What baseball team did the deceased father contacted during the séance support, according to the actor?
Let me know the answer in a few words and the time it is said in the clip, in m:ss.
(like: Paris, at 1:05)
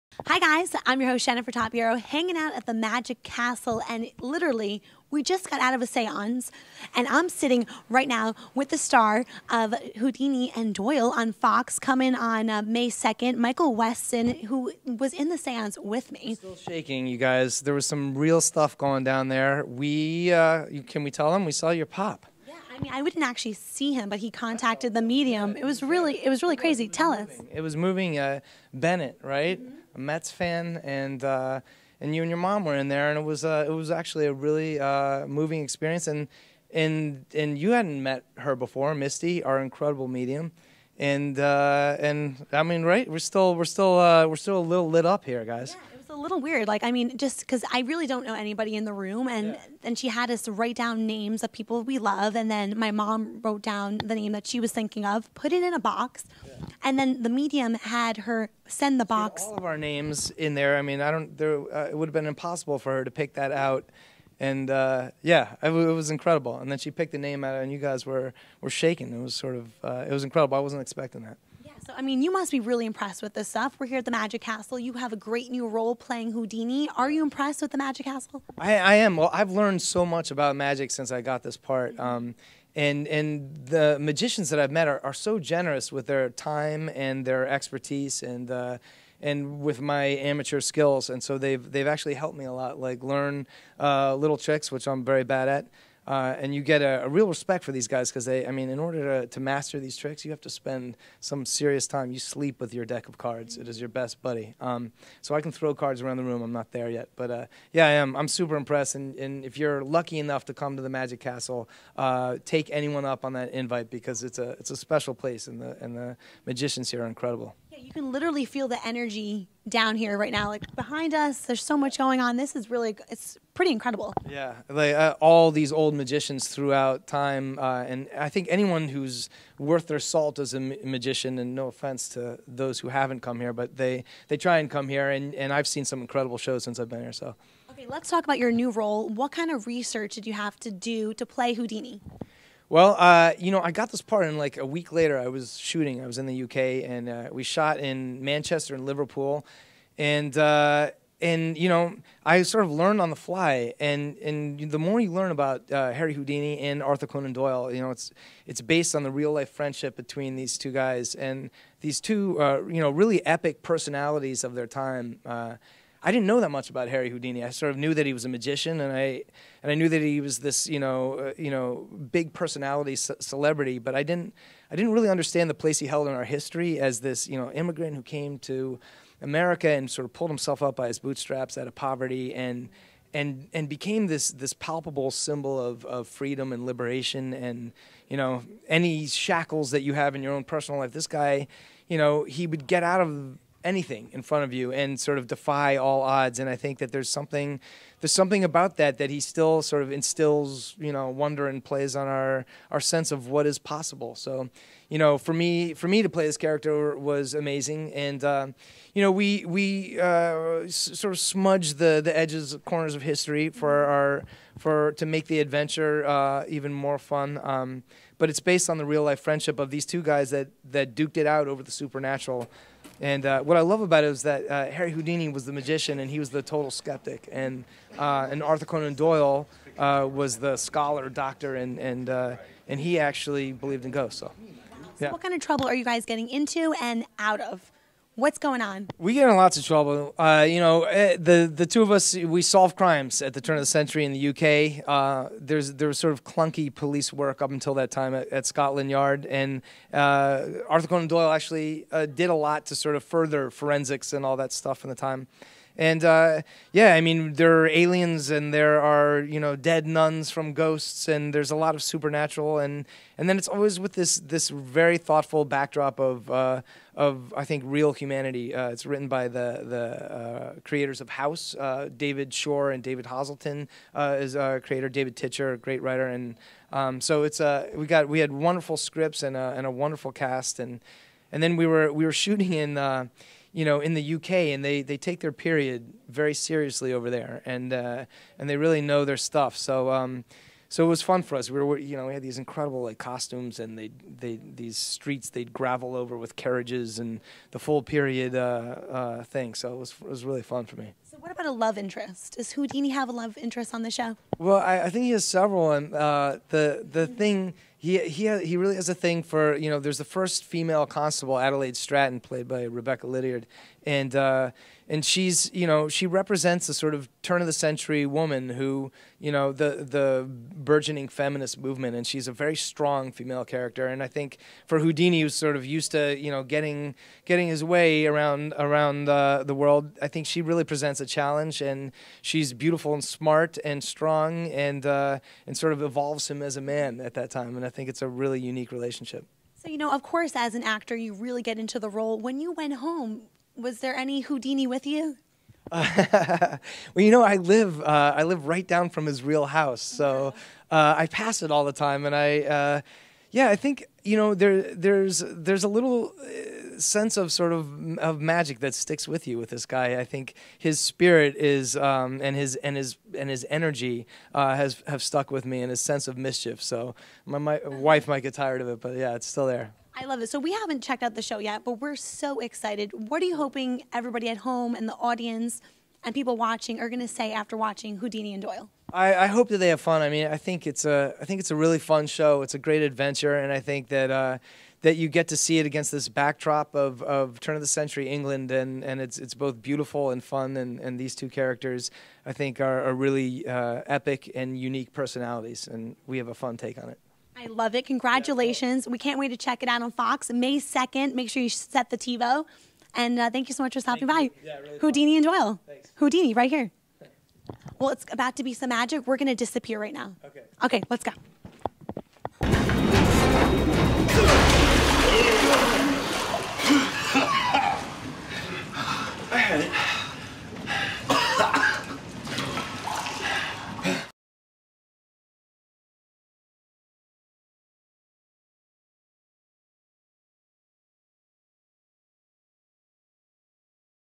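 Mets, at 0:29.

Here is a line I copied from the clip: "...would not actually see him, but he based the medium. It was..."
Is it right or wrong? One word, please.
wrong.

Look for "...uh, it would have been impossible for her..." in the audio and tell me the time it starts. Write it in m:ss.
1:01.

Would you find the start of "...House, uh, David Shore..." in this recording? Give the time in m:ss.
4:31.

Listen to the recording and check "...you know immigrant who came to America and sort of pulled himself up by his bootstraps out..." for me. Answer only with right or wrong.
right.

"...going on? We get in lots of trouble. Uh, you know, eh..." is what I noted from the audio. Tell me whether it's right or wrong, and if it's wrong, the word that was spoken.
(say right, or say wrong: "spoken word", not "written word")
right.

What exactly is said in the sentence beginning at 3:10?
This guy, you know, he would get out of anything in front of you and sort of defy all odds.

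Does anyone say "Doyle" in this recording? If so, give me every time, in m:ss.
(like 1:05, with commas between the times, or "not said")
0:10, 2:37, 3:48, 4:11, 6:18, 6:45.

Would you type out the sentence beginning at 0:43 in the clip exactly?
We're still we're still uh, we're still a little lit up here, guys.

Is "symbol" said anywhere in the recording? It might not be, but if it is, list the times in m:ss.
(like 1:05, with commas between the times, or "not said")
3:05.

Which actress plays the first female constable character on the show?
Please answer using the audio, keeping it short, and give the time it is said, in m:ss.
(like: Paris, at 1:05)
Rebecca Lydiard, at 5:12.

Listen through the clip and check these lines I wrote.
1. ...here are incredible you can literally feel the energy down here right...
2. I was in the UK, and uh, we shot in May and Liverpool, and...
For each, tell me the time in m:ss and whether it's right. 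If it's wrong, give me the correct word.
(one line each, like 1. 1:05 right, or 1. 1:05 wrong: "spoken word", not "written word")
1. 1:56 right
2. 2:26 wrong: "Manchester", not "May".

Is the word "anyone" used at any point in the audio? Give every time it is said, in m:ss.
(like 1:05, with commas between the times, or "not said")
1:52, 2:08.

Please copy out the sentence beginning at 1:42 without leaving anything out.
You sleep with your deck of cards, it is your best buddy.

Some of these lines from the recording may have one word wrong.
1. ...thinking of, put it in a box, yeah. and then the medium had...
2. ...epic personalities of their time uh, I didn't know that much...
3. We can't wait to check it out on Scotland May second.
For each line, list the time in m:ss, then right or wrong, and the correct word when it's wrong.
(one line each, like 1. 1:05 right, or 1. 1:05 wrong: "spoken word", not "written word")
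1. 0:54 right
2. 2:43 right
3. 6:38 wrong: "Fox", not "Scotland".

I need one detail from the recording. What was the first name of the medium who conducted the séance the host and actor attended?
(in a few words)
Misty.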